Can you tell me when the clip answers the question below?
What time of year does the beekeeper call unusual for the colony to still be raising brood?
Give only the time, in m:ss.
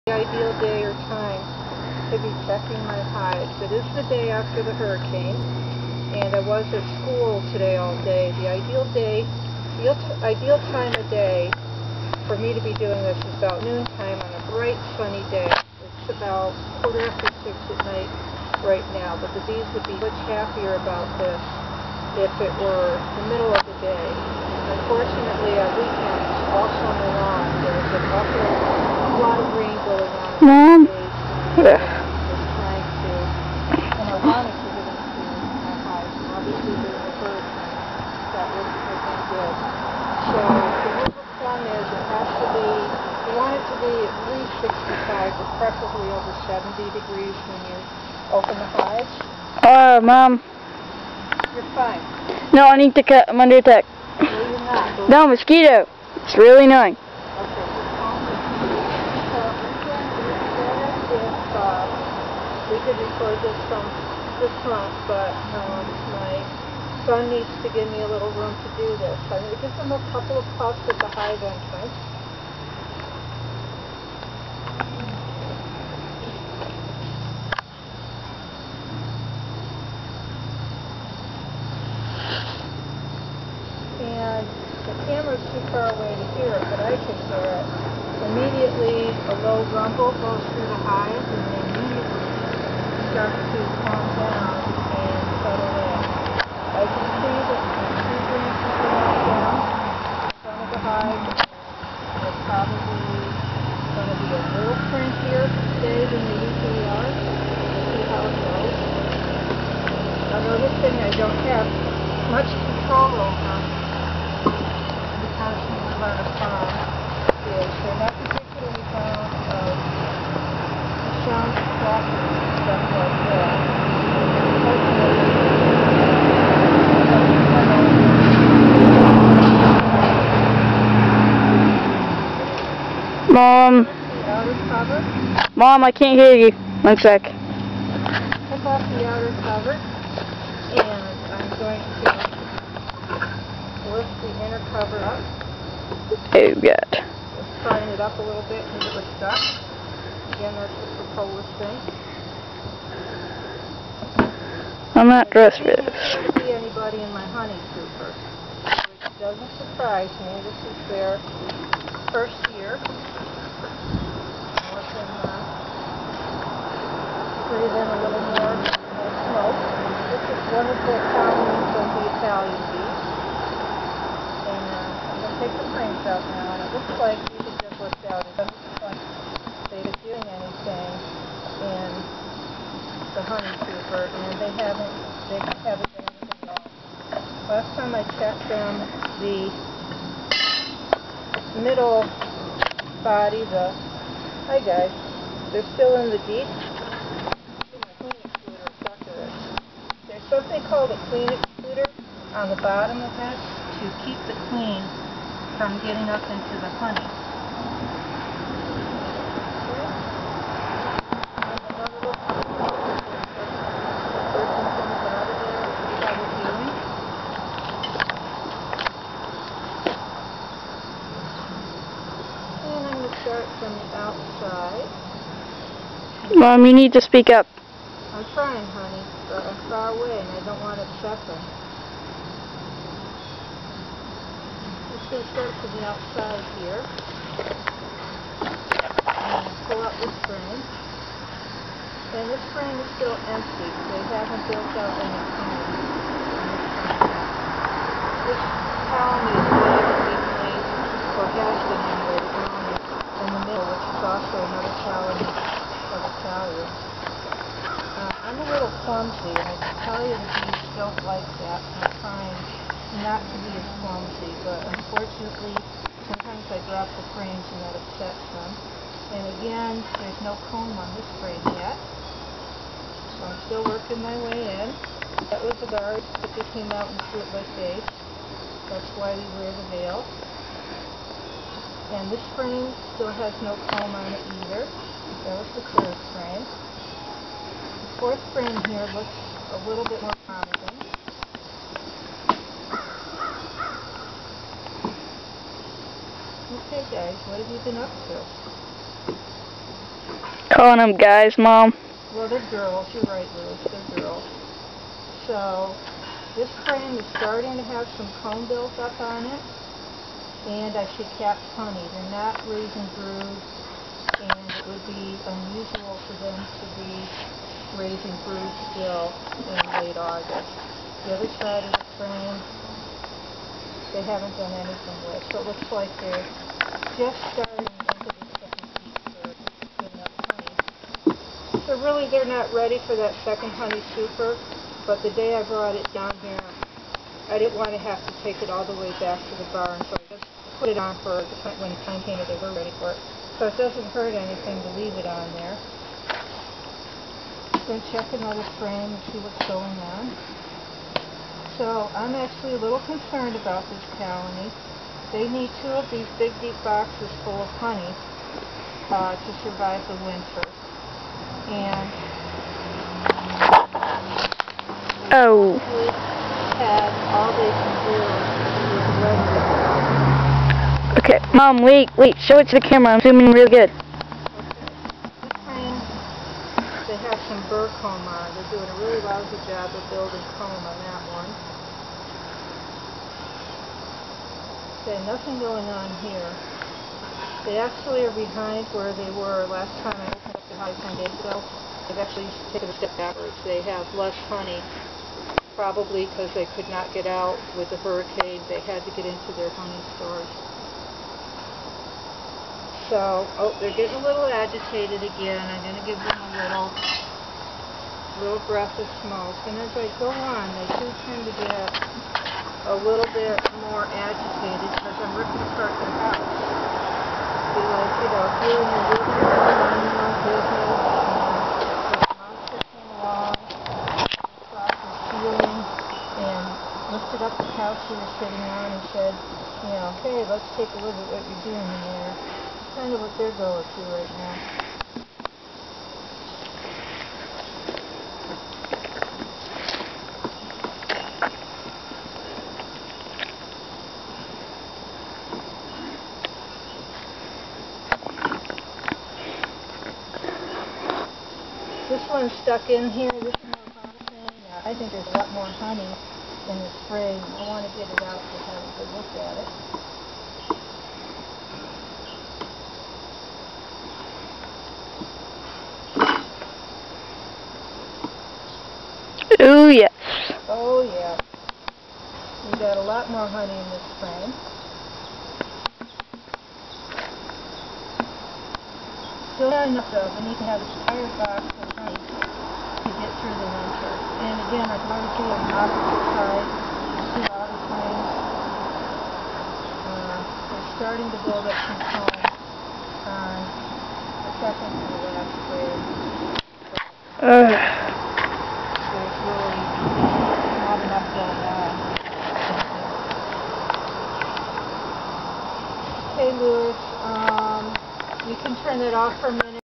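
5:19.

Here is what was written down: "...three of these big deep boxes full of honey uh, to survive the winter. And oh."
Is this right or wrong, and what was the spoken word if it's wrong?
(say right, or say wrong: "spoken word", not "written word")
wrong: "two", not "three".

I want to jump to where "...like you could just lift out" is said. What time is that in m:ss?
2:57.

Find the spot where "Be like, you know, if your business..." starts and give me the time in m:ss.
6:57.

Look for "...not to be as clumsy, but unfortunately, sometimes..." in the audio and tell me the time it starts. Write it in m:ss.
4:23.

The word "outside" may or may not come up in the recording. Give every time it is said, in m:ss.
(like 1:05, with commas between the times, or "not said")
3:43, 3:55.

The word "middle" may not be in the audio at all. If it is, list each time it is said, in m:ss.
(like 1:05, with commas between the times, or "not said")
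0:23, 3:11.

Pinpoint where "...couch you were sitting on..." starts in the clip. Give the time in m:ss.
7:07.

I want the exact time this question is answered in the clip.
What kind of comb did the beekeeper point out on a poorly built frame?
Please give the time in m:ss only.
6:17.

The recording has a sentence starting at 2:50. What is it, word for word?
This is one of the fountains of the Italian bees.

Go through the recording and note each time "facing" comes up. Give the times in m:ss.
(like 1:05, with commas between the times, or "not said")
not said.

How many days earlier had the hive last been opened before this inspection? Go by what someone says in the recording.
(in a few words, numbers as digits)
10 days.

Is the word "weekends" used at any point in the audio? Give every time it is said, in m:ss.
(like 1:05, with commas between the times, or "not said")
0:25.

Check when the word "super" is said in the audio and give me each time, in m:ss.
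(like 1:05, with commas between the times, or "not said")
2:37, 3:03, 5:33.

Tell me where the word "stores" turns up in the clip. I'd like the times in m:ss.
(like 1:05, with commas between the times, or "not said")
6:39.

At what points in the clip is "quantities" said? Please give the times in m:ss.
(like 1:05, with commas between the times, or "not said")
not said.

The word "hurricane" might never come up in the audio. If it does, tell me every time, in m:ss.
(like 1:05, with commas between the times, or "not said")
0:04, 6:37.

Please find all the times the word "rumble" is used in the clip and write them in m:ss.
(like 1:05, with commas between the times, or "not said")
1:29.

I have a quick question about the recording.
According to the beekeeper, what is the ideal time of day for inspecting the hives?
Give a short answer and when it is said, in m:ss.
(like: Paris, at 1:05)
noontime, at 0:13.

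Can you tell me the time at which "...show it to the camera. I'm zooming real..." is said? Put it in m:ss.
6:12.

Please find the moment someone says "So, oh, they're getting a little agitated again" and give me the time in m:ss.
6:42.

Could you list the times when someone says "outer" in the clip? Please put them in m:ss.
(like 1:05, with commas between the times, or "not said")
2:19.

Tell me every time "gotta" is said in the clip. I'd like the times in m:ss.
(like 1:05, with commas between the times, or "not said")
not said.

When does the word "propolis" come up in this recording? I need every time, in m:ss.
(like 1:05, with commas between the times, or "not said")
2:31.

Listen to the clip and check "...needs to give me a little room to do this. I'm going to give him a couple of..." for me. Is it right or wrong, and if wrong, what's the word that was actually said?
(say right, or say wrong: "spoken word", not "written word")
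right.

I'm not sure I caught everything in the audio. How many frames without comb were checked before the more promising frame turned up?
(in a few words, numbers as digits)
3.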